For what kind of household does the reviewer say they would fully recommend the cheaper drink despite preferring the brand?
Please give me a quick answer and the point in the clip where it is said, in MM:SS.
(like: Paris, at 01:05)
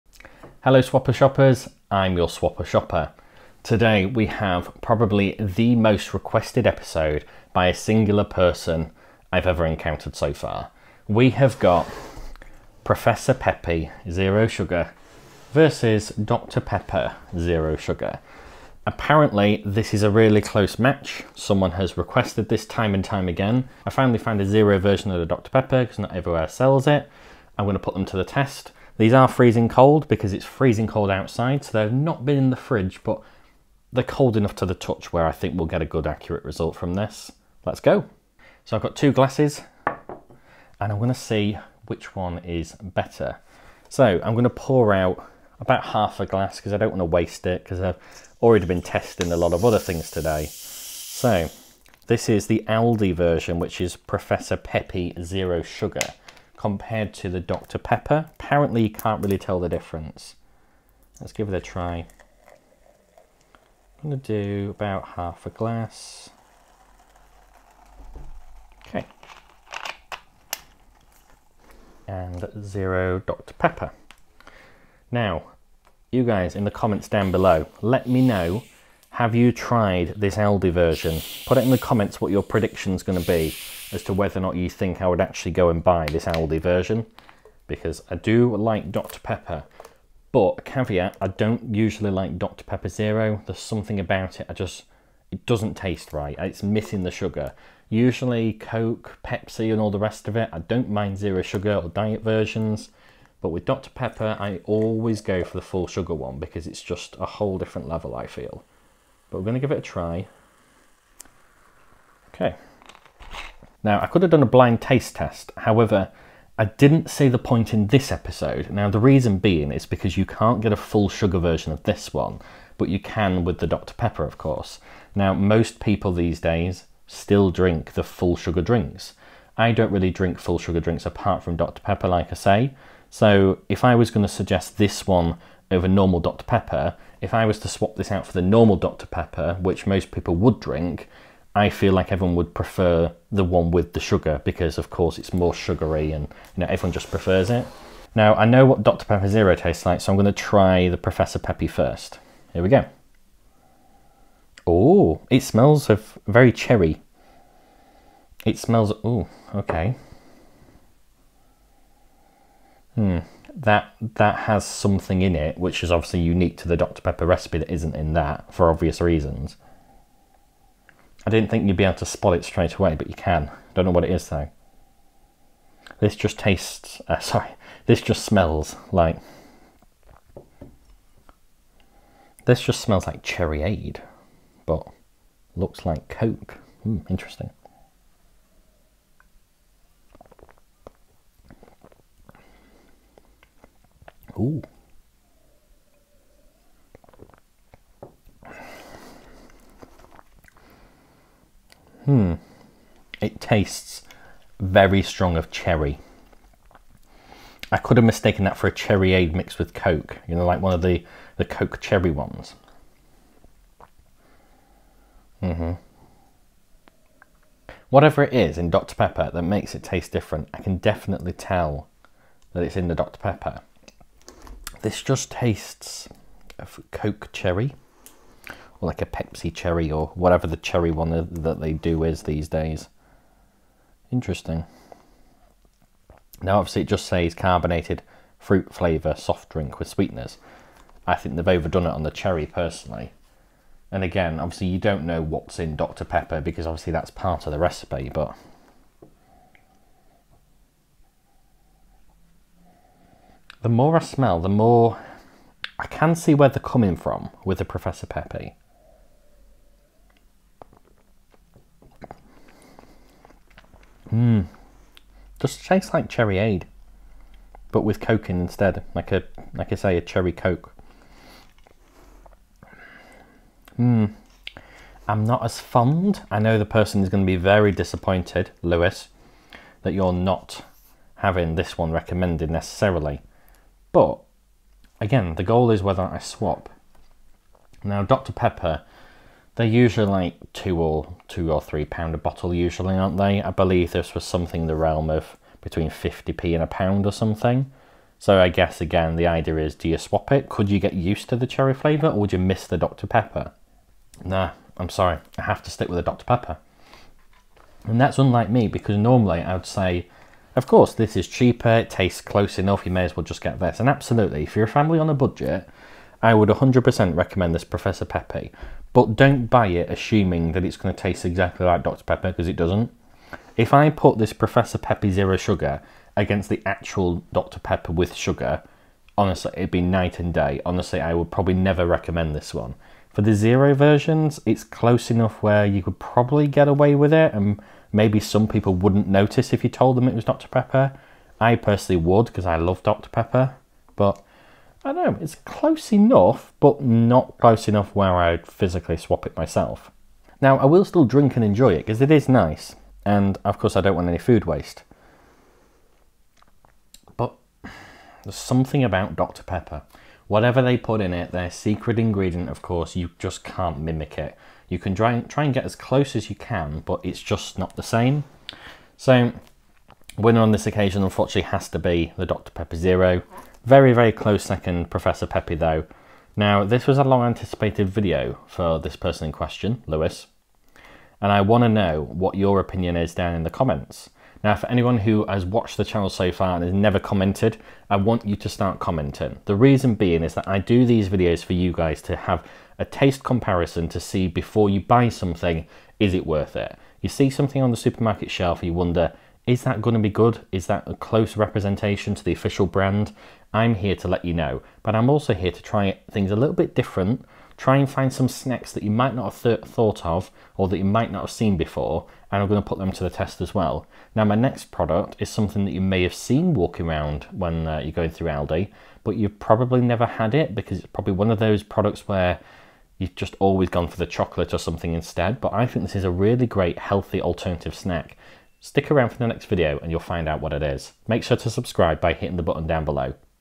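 A family on a budget, at 05:14.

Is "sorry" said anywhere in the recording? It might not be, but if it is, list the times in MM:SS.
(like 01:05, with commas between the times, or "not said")
02:57, 05:04.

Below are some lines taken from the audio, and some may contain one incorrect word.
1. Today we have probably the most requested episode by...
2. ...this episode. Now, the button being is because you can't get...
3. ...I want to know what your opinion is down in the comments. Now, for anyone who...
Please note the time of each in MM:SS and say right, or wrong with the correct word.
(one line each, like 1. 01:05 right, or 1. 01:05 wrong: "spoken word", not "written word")
1. 00:03 right
2. 01:57 wrong: "reason", not "button"
3. 06:21 right.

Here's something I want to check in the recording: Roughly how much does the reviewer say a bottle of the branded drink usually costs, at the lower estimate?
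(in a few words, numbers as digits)
£2.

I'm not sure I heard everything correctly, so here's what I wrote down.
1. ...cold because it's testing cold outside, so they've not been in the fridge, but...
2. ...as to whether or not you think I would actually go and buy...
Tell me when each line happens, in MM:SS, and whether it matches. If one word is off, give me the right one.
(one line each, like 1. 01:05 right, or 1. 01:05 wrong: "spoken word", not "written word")
1. 00:29 wrong: "freezing", not "testing"
2. 01:23 right.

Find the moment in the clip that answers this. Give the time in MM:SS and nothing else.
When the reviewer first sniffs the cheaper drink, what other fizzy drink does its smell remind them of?
03:03.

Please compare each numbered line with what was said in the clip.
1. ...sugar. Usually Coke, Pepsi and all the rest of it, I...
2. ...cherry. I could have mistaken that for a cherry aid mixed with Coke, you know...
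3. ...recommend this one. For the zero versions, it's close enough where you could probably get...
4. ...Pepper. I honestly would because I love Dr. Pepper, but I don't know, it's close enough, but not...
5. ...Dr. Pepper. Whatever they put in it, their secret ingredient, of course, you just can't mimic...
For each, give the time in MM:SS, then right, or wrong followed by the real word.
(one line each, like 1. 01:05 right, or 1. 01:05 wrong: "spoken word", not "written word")
1. 01:37 right
2. 03:25 right
3. 05:31 right
4. 05:40 wrong: "personally", not "honestly"
5. 05:59 right.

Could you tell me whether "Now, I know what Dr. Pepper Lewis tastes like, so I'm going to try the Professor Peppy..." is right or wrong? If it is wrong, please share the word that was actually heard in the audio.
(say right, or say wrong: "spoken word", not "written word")
wrong: "Zero", not "Lewis".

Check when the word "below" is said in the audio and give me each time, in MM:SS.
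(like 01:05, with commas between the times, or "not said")
01:17, 07:12.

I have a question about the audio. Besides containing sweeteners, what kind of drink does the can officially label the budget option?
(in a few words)
Carbonated fruit flavour soft drink.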